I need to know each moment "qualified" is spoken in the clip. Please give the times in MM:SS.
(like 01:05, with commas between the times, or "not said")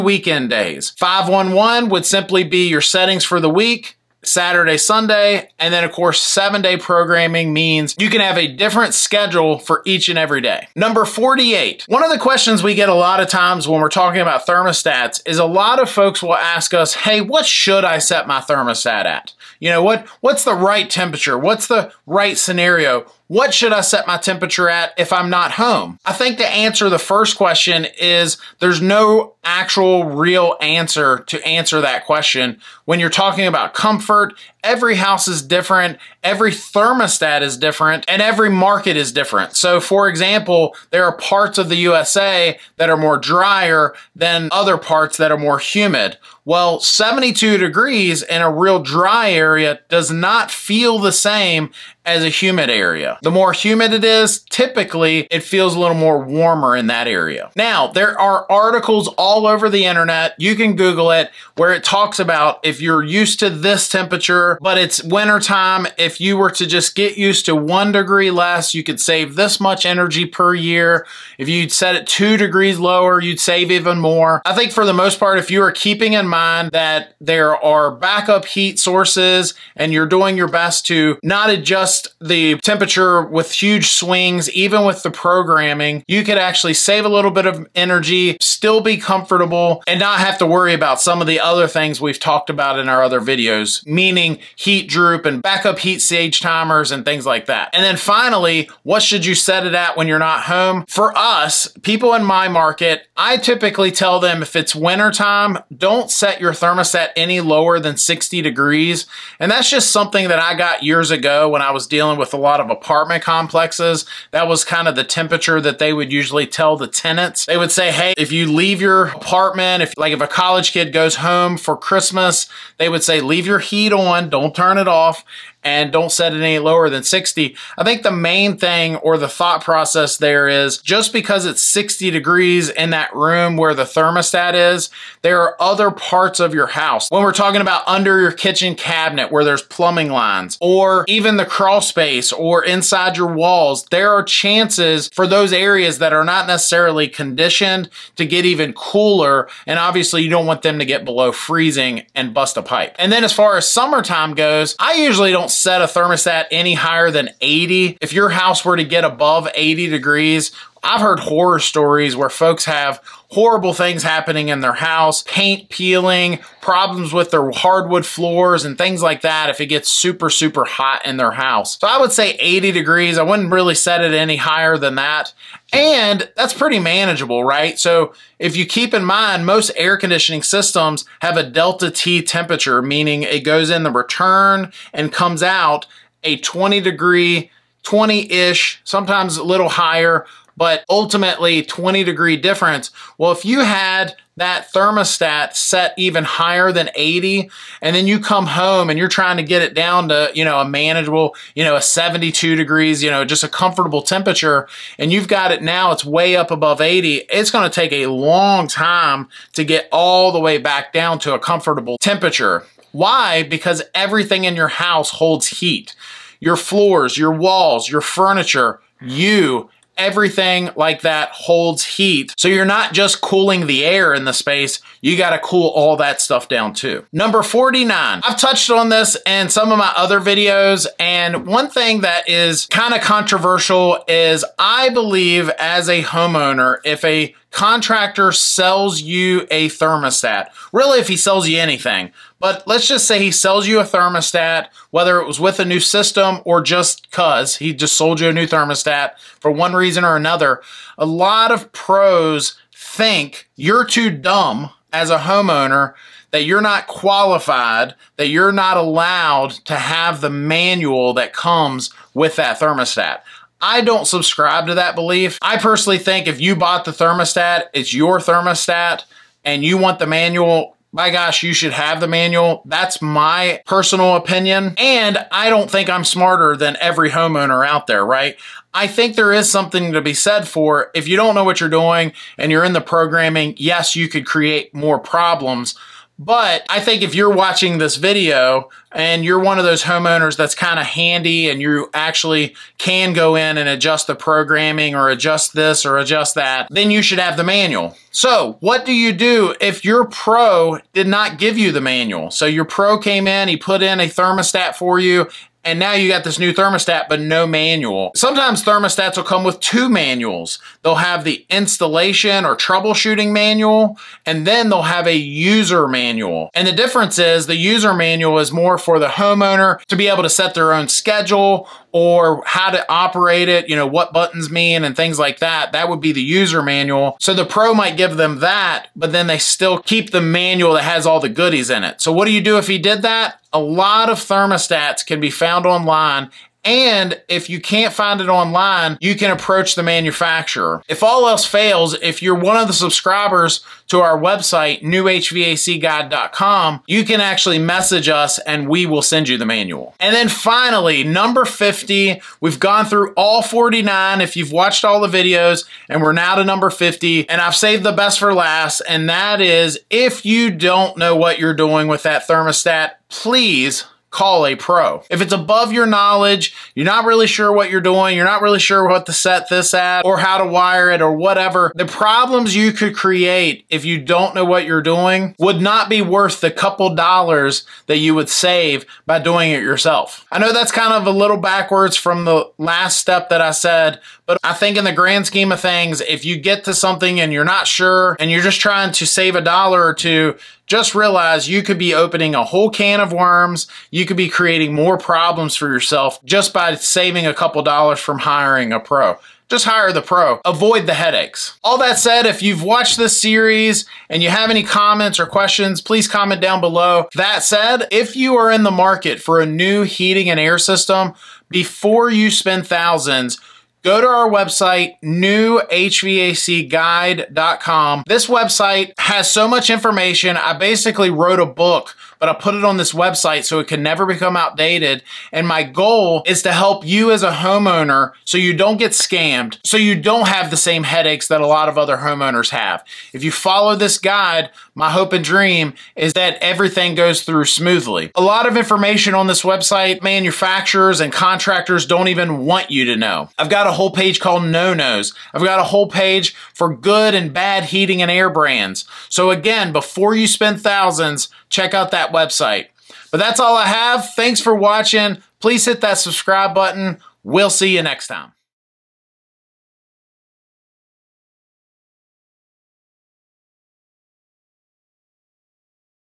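04:16.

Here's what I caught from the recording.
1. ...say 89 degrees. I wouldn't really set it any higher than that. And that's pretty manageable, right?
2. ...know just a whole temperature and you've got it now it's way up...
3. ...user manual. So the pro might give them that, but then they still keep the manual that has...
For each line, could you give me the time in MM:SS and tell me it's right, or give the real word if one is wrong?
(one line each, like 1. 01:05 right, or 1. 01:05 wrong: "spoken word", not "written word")
1. 02:52 wrong: "80", not "89"
2. 03:23 wrong: "comfortable", not "whole"
3. 05:26 right.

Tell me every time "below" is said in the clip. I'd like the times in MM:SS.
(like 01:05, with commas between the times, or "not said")
02:31, 06:46.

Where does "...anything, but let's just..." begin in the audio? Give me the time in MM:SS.
04:01.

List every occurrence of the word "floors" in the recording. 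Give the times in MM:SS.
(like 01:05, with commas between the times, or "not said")
02:48, 03:36.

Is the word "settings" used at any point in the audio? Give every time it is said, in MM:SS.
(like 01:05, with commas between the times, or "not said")
00:02.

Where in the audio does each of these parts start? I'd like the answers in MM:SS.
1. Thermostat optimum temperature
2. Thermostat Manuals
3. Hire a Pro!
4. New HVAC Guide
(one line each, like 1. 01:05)
1. 00:10
2. 03:47
3. 05:50
4. 06:47.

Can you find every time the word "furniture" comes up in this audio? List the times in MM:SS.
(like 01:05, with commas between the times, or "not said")
03:38.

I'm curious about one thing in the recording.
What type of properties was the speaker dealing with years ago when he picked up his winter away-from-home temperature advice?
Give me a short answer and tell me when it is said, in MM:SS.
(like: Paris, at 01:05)
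apartment complexes, at 01:52.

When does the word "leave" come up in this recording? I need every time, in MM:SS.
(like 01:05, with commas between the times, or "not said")
01:58, 02:03.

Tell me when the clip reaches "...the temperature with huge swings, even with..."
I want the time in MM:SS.
01:22.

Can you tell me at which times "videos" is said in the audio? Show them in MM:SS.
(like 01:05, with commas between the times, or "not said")
01:33, 03:50, 04:47, 05:55.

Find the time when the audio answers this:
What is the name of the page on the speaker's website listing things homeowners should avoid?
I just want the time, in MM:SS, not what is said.
07:24.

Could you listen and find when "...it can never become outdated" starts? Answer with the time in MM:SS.
07:03.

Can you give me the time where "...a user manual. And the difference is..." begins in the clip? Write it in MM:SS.
05:15.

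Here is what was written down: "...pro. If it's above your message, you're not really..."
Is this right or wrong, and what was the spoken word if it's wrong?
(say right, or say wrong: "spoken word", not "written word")
wrong: "knowledge", not "message".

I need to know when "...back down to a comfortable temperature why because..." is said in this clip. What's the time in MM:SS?
03:30.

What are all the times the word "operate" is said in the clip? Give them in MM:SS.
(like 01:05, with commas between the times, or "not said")
05:22.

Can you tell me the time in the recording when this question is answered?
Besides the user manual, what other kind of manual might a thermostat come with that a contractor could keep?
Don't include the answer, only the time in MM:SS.
05:11.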